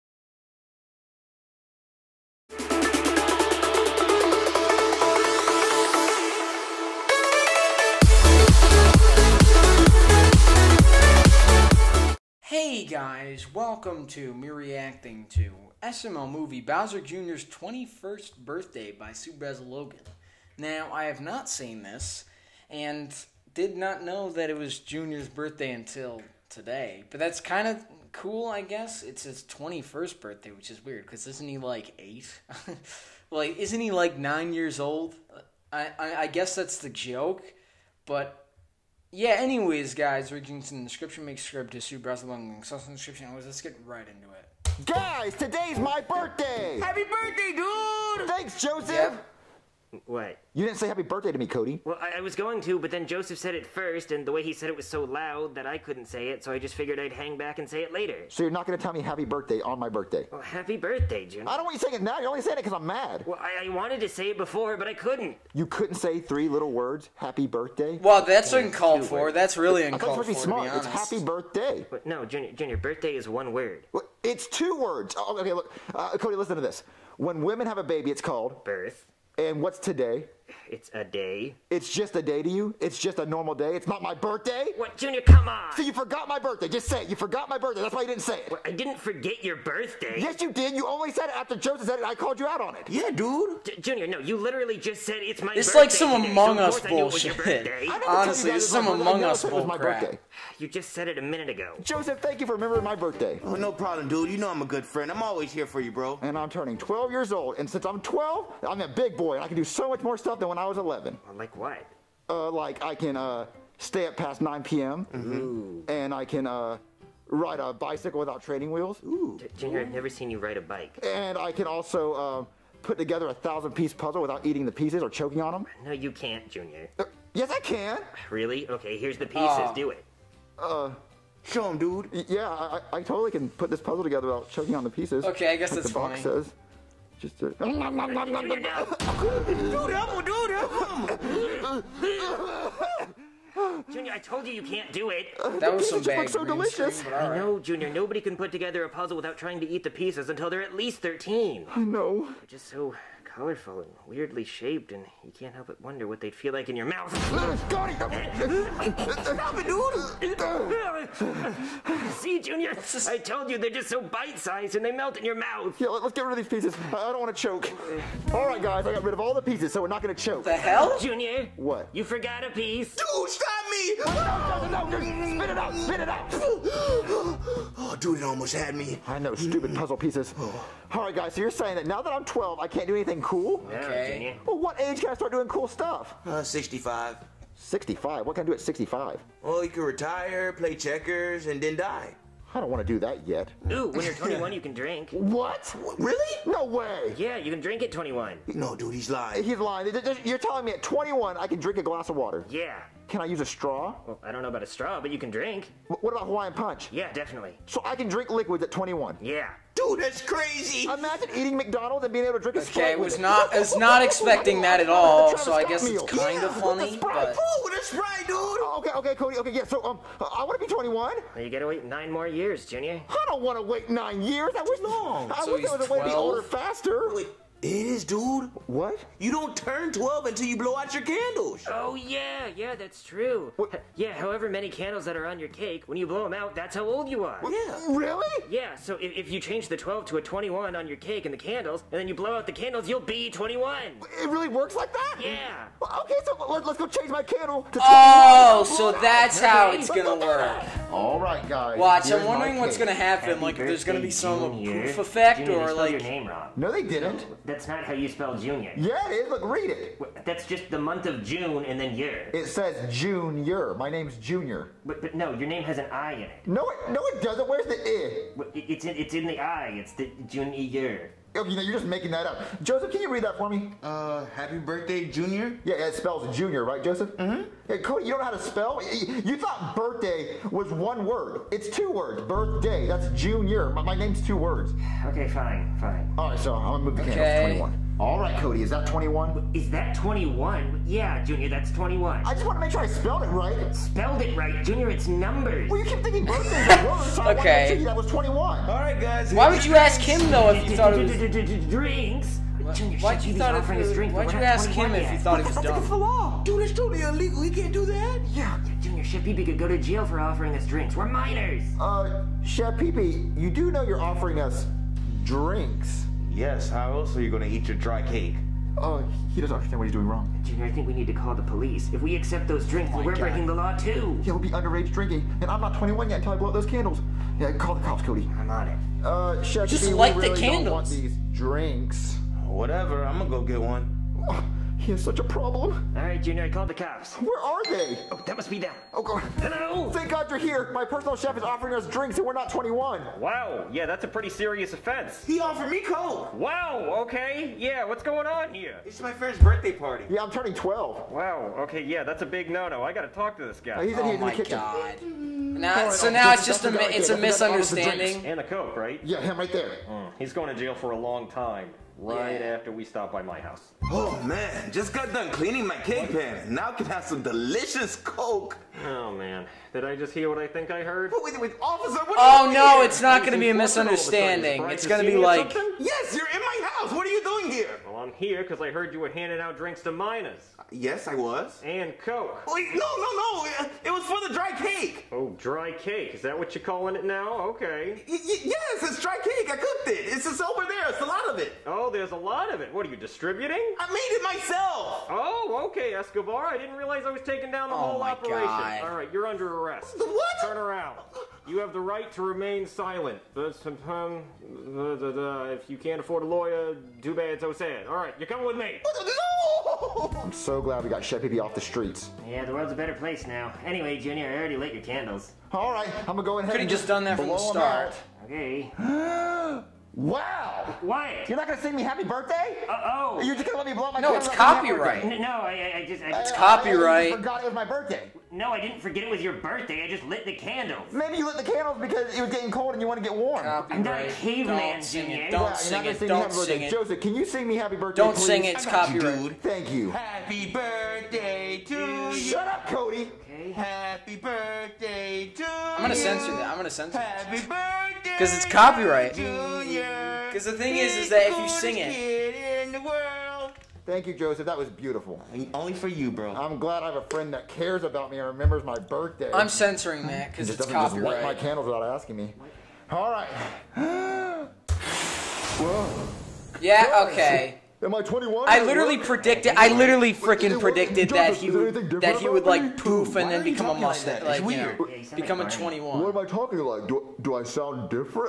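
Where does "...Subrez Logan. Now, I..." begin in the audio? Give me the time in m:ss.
0:19.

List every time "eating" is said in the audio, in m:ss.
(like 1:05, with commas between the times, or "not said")
2:04, 3:31.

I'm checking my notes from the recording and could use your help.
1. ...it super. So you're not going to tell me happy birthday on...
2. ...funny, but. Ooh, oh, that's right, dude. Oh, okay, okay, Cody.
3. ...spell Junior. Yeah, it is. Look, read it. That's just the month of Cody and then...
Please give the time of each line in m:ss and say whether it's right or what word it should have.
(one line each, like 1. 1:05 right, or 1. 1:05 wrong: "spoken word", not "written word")
1. 0:57 wrong: "later", not "super"
2. 3:36 right
3. 4:18 wrong: "June", not "Cody".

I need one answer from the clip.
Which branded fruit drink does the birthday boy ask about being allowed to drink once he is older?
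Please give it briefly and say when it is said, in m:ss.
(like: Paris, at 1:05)
Hawaiian Punch, at 3:26.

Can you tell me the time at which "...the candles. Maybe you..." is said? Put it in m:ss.
7:10.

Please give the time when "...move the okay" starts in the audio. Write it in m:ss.
4:46.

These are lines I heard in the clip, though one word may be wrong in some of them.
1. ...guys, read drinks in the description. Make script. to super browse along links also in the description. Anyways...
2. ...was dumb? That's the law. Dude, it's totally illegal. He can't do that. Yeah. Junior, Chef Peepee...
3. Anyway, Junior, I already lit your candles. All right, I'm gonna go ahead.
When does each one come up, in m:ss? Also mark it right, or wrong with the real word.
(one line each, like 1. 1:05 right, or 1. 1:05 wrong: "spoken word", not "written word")
1. 0:39 wrong: "links", not "drinks"
2. 5:05 right
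3. 6:53 right.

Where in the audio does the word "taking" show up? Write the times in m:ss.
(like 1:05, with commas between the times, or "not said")
6:37.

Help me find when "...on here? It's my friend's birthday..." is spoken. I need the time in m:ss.
5:48.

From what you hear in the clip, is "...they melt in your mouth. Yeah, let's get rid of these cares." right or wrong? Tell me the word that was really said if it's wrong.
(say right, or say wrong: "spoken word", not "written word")
wrong: "pieces", not "cares".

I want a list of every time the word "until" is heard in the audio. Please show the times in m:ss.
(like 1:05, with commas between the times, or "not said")
0:25, 2:30, 3:50, 5:26.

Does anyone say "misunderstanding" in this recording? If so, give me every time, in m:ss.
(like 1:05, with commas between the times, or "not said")
5:57, 6:13.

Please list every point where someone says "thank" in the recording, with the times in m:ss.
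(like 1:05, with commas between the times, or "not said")
0:48, 1:42, 5:39, 7:19, 7:33.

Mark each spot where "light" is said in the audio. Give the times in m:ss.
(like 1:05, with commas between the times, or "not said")
5:29, 7:41.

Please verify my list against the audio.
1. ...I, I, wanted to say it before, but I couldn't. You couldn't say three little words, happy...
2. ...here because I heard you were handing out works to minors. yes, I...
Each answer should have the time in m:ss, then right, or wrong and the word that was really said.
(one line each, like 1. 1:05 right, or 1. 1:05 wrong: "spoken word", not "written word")
1. 1:03 right
2. 6:18 wrong: "drinks", not "works".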